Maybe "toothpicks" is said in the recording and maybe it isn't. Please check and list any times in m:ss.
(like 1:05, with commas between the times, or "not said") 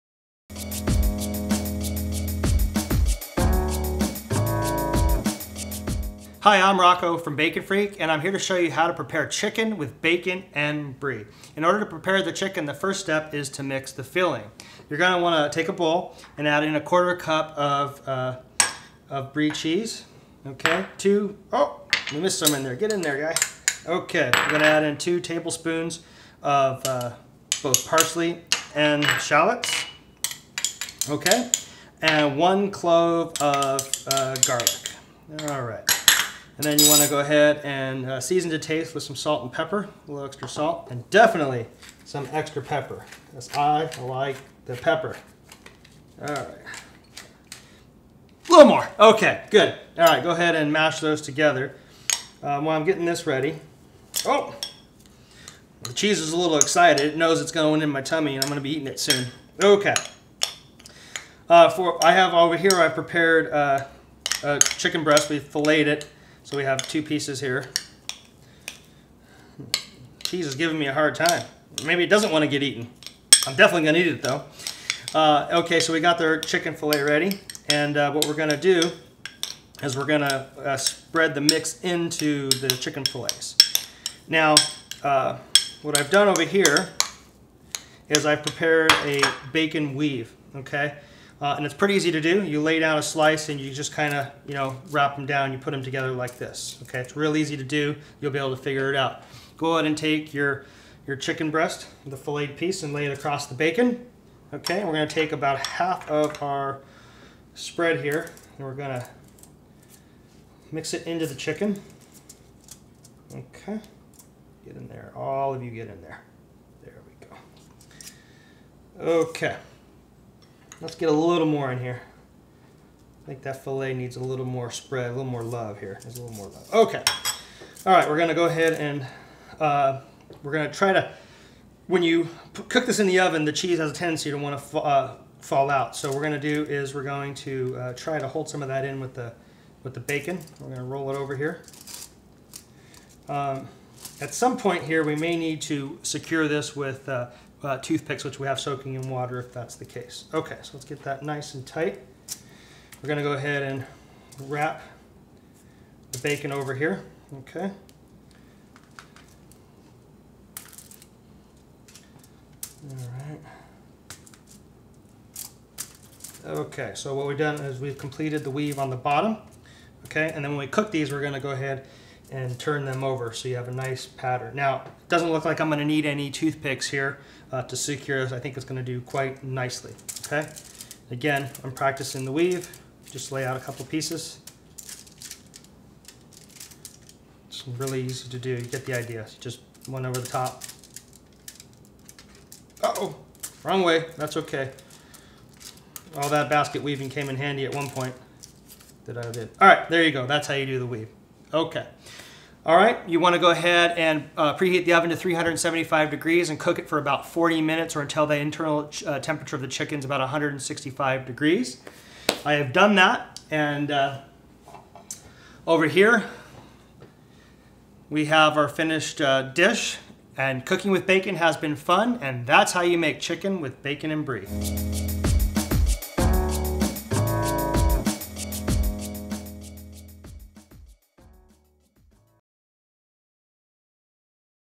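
2:27, 2:56.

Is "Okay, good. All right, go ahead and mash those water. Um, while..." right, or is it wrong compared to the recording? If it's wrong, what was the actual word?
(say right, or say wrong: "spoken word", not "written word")
wrong: "together", not "water".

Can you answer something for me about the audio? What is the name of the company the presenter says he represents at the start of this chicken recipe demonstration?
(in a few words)
Bacon Freak.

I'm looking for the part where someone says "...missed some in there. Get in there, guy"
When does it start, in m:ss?
0:22.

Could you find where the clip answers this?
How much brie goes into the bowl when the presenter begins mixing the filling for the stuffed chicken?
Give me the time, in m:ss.
0:16.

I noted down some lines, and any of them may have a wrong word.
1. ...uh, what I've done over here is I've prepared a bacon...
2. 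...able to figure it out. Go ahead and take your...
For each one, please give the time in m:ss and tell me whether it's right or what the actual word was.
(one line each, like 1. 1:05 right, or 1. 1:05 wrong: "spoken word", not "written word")
1. 1:25 right
2. 1:38 right.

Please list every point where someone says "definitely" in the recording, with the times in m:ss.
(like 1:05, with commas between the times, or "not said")
0:41, 1:13.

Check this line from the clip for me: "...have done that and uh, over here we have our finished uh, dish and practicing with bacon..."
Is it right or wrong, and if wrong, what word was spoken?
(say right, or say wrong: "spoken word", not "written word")
wrong: "cooking", not "practicing".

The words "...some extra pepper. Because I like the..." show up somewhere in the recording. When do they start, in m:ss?
0:42.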